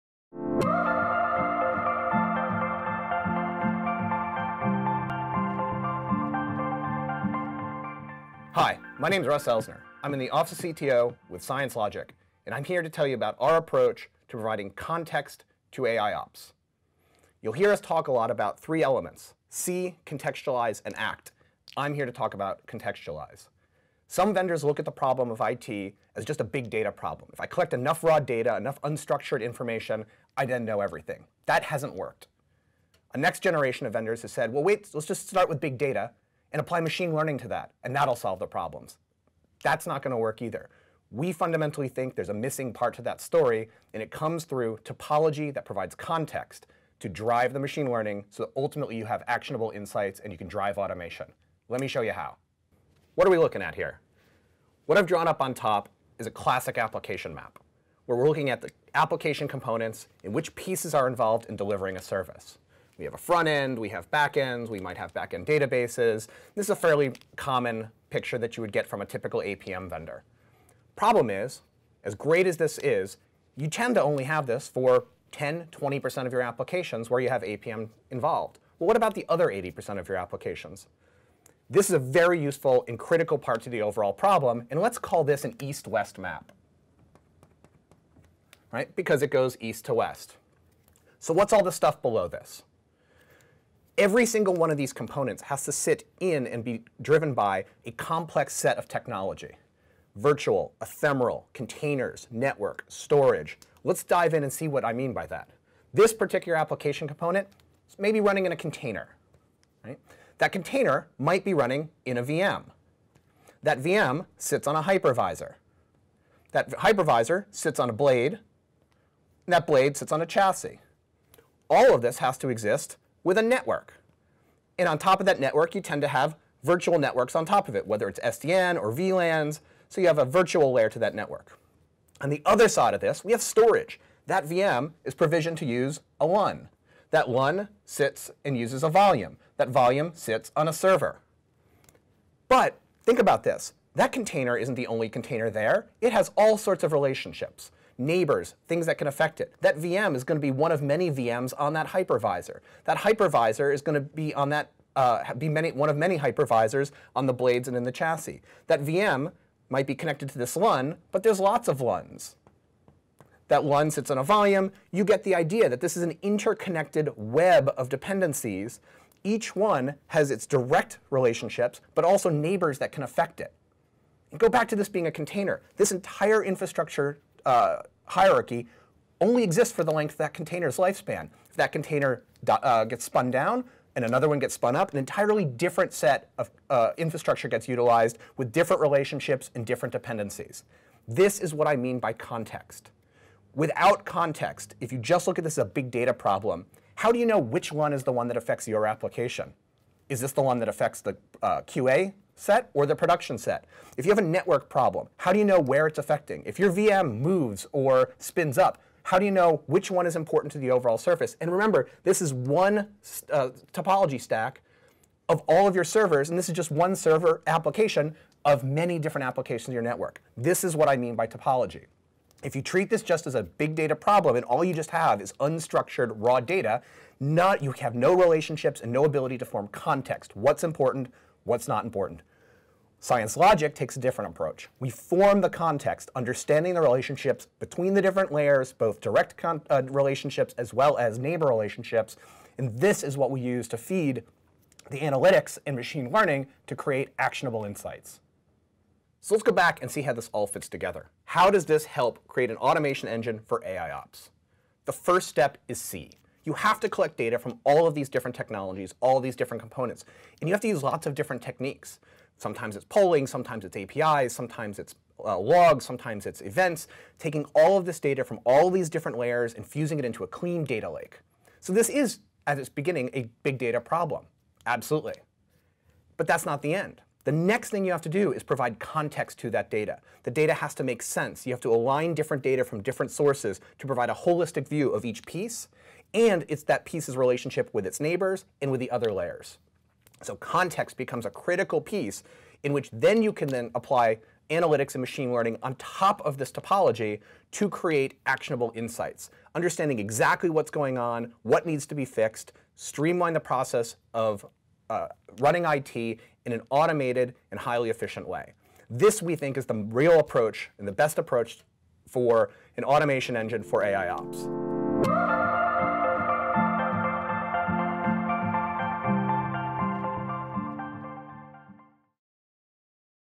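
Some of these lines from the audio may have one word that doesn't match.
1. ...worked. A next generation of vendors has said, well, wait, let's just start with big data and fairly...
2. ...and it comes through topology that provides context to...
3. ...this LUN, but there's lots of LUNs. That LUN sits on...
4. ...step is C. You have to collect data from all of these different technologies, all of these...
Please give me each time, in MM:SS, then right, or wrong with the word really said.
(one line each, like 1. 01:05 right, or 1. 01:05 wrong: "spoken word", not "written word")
1. 00:31 wrong: "apply", not "fairly"
2. 00:43 right
3. 02:40 right
4. 04:15 right.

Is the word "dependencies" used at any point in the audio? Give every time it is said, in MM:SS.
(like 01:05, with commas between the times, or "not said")
02:47, 03:09.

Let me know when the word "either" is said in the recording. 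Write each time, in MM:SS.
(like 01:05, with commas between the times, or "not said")
00:40.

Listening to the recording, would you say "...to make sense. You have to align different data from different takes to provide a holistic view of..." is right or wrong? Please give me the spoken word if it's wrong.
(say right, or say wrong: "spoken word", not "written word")
wrong: "sources", not "takes".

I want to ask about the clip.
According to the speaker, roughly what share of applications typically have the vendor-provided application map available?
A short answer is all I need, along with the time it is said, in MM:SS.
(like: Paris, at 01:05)
10-20%, at 01:15.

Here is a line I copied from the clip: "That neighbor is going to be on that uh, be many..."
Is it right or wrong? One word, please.
wrong.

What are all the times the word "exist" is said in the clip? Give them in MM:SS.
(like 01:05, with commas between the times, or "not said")
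02:02, 02:59.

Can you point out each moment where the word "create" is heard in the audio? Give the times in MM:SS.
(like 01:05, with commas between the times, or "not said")
04:06, 04:12, 04:57.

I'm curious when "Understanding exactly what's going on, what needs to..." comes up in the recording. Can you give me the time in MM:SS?
04:59.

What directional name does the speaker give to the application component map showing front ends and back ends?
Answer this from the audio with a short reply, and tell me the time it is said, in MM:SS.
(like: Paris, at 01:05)
east-west map, at 01:25.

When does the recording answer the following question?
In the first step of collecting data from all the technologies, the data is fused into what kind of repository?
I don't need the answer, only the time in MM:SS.
04:30.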